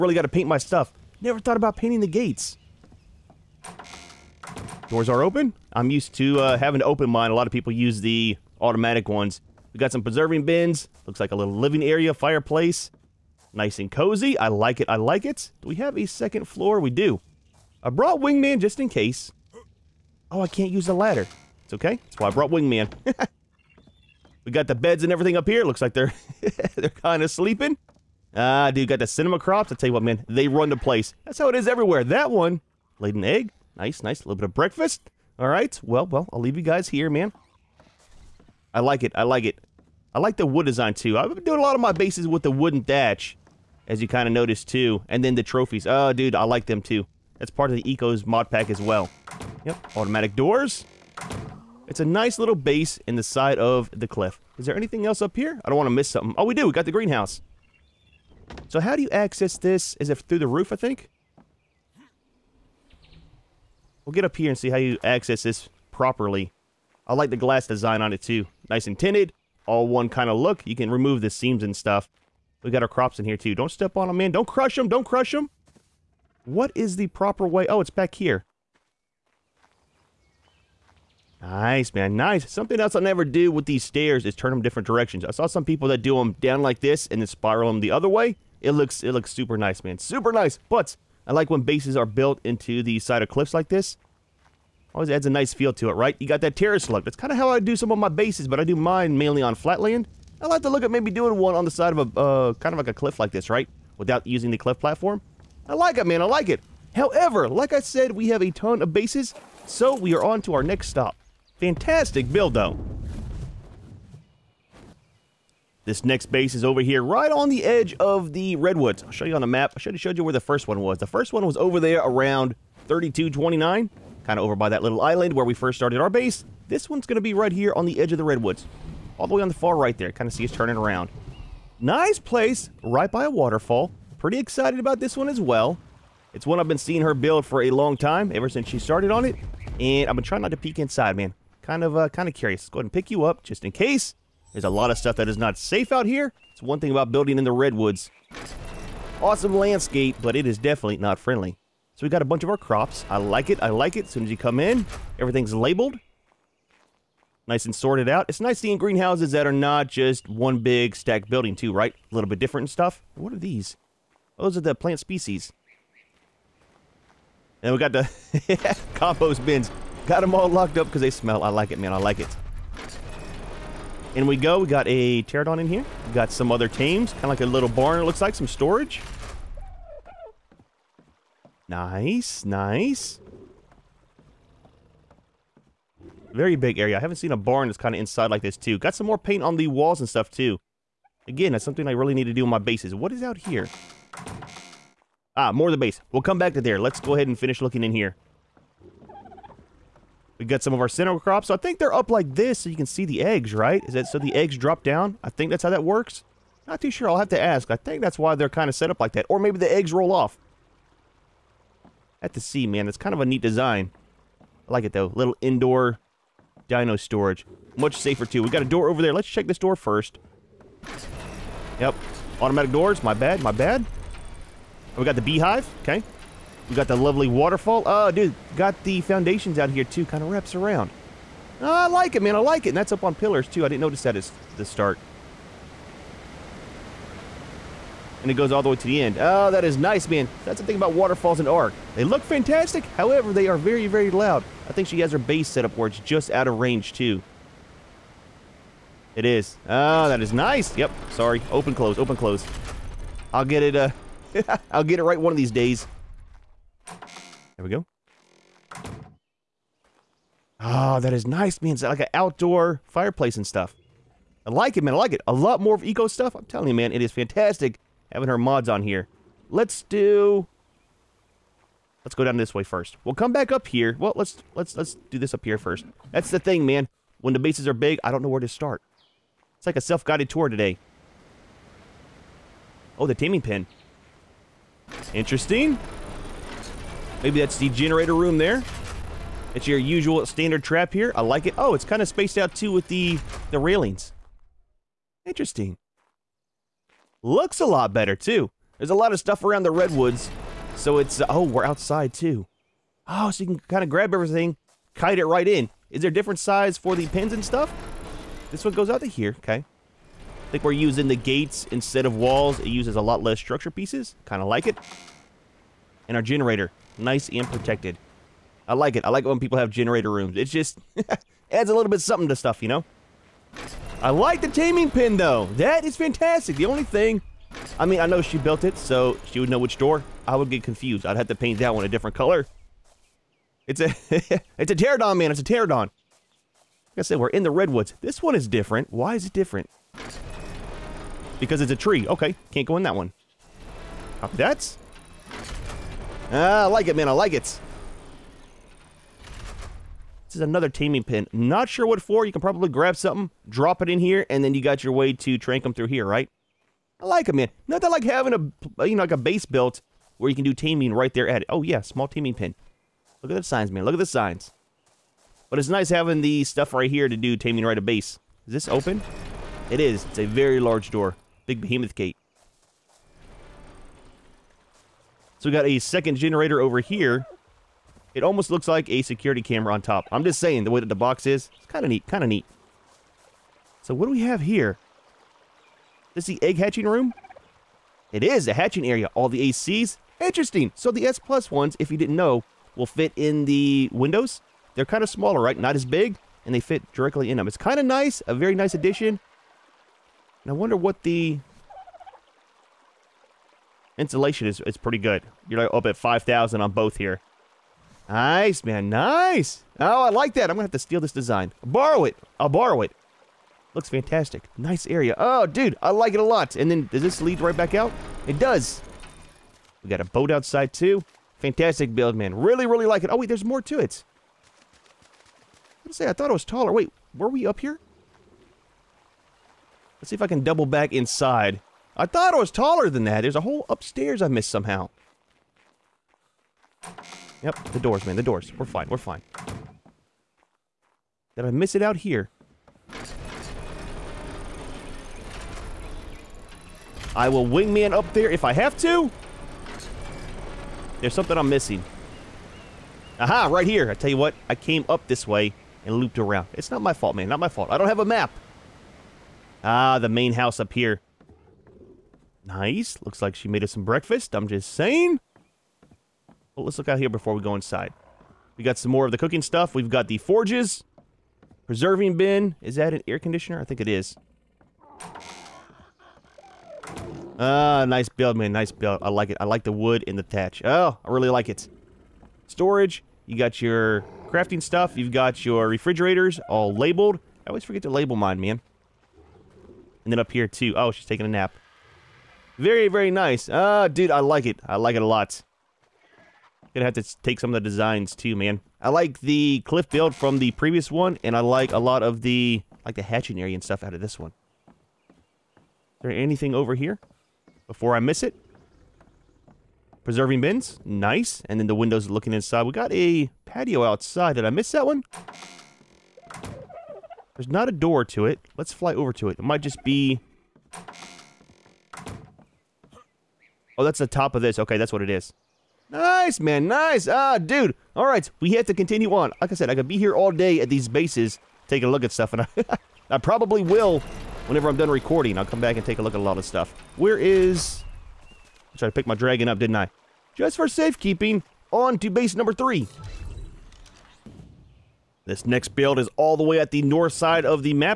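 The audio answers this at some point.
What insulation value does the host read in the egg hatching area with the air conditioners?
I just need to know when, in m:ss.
6:45.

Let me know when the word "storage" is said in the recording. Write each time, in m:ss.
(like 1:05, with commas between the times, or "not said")
2:58, 3:36, 8:02.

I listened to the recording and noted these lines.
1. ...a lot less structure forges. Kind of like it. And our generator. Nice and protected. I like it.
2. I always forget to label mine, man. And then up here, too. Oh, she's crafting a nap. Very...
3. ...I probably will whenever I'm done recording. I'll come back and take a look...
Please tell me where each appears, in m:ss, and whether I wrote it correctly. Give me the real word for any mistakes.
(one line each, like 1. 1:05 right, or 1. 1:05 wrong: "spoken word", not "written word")
1. 5:12 wrong: "pieces", not "forges"
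2. 8:07 wrong: "taking", not "crafting"
3. 8:53 right.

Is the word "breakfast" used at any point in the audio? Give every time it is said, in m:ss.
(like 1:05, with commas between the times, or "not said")
0:34, 7:43.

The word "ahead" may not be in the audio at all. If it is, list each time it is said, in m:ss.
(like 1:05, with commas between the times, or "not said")
2:22, 3:17.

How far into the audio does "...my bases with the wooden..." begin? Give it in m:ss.
0:41.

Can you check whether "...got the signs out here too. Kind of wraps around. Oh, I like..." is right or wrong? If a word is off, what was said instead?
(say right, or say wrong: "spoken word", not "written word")
wrong: "foundations", not "signs".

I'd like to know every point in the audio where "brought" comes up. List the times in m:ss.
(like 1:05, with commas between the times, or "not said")
0:17, 0:22.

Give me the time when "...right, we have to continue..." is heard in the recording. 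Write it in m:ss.
8:48.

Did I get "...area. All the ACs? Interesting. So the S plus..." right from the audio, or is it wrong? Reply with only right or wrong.
right.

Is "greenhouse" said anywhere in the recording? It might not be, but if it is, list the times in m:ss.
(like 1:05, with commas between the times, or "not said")
0:56, 2:38.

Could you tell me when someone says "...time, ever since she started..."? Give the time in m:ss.
2:17.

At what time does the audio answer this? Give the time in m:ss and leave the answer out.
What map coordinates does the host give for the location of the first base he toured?
2:02.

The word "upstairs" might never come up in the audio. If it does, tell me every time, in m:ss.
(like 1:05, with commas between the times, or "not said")
7:13.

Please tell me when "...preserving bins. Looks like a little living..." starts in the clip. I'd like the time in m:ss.
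0:10.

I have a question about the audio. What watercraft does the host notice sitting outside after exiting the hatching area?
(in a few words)
boat.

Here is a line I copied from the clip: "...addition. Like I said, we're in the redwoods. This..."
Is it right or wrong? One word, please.
wrong.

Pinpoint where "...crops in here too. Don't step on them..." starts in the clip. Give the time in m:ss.
1:12.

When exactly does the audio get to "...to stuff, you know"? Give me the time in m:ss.
5:22.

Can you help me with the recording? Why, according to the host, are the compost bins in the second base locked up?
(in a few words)
they smell.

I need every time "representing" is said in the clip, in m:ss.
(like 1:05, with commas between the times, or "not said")
not said.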